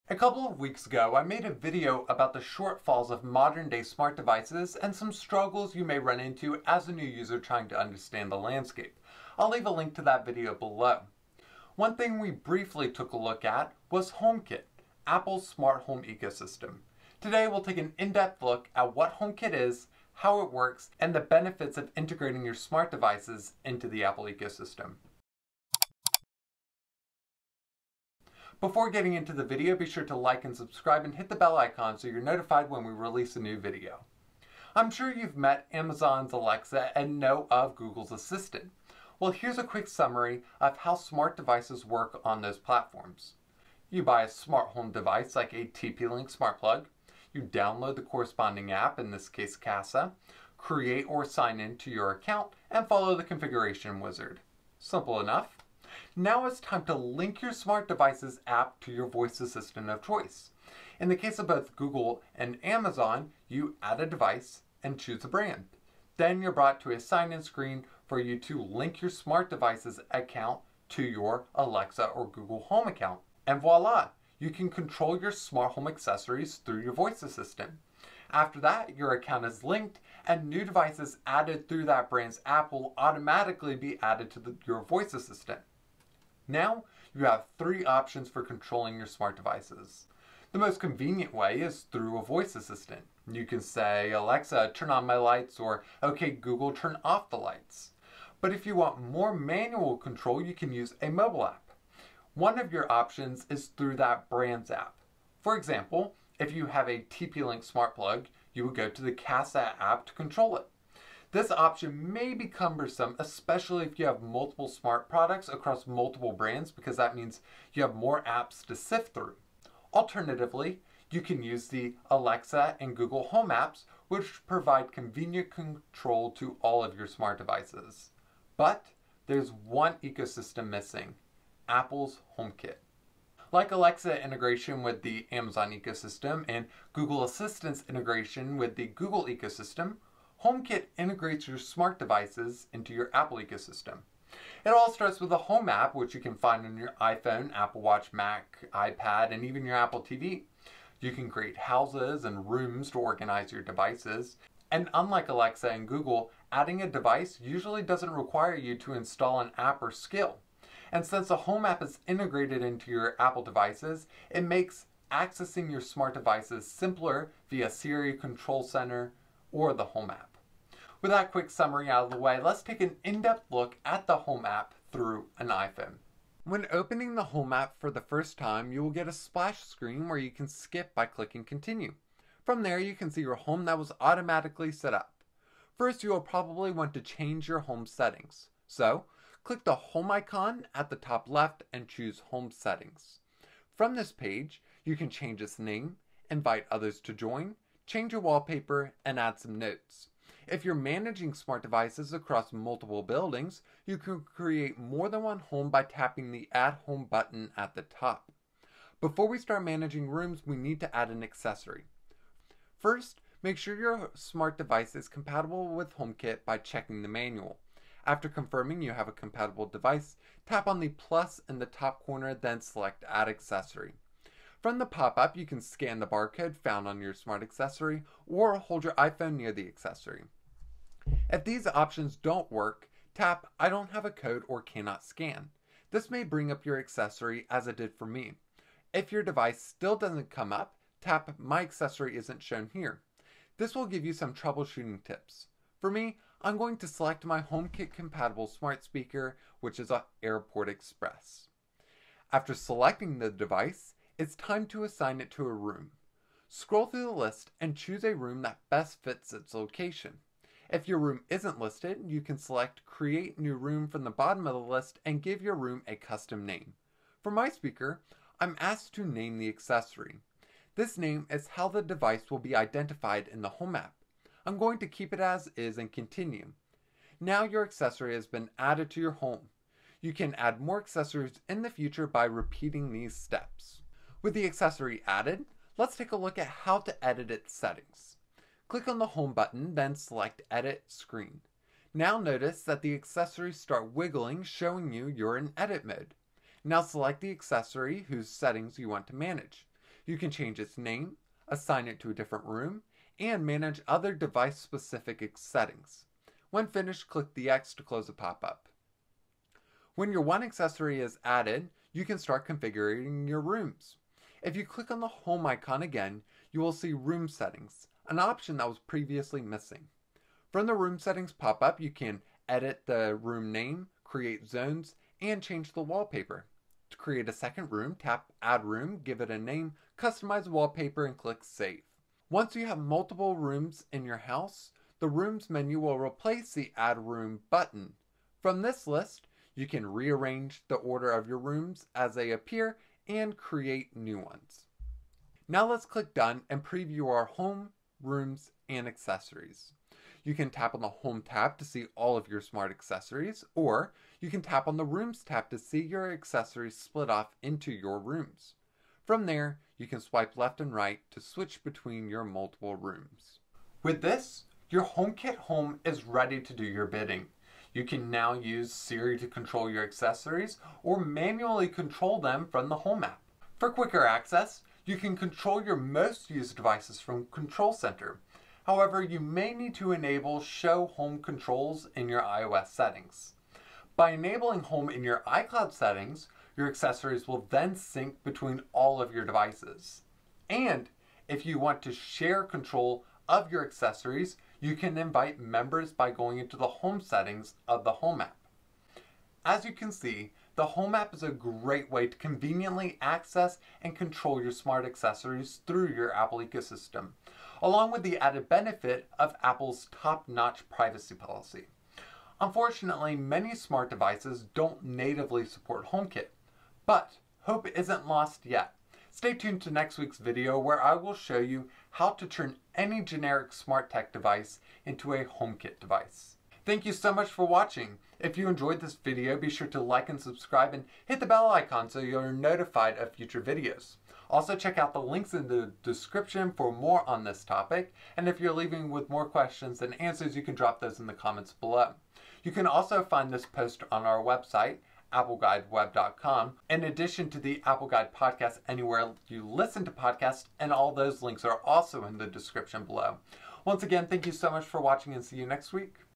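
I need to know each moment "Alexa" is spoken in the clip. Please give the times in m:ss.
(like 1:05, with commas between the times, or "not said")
0:36, 1:11, 1:34, 2:02, 2:13, 2:35.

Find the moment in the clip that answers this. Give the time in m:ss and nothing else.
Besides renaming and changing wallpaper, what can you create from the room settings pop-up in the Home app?
5:24.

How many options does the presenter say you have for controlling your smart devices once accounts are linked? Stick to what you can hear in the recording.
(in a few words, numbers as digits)
3.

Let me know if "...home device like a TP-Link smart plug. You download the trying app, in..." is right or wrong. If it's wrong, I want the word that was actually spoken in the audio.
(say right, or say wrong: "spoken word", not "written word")
wrong: "corresponding", not "trying".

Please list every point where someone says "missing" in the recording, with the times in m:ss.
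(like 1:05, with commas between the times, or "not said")
2:10, 5:19.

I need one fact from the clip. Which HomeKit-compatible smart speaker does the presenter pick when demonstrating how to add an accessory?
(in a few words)
AirPort Express.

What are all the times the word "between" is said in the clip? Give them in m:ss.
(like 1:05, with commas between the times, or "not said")
6:01, 6:28.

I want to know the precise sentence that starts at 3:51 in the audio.
If these options don't work, tap I don't have a code or cannot scan.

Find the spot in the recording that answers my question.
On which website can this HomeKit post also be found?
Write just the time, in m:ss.
7:25.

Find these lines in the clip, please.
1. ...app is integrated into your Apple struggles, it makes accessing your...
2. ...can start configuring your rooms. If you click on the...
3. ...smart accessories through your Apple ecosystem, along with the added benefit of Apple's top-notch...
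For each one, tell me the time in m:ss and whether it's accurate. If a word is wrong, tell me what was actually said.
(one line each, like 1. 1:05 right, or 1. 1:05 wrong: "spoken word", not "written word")
1. 2:41 wrong: "devices", not "struggles"
2. 5:12 right
3. 6:44 right.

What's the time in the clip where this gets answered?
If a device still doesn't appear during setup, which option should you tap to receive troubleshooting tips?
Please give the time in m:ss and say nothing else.
4:01.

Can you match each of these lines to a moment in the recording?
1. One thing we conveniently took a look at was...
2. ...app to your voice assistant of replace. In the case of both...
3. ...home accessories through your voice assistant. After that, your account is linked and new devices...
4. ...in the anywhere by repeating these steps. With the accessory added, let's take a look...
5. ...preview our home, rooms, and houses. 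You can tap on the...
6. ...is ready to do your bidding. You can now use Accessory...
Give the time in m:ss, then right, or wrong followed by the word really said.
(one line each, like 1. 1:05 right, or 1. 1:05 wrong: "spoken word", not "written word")
1. 0:11 wrong: "briefly", not "conveniently"
2. 0:58 wrong: "choice", not "replace"
3. 1:15 right
4. 4:41 wrong: "future", not "anywhere"
5. 5:46 wrong: "accessories", not "houses"
6. 6:05 wrong: "Siri", not "Accessory".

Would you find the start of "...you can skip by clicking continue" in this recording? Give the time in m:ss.
3:00.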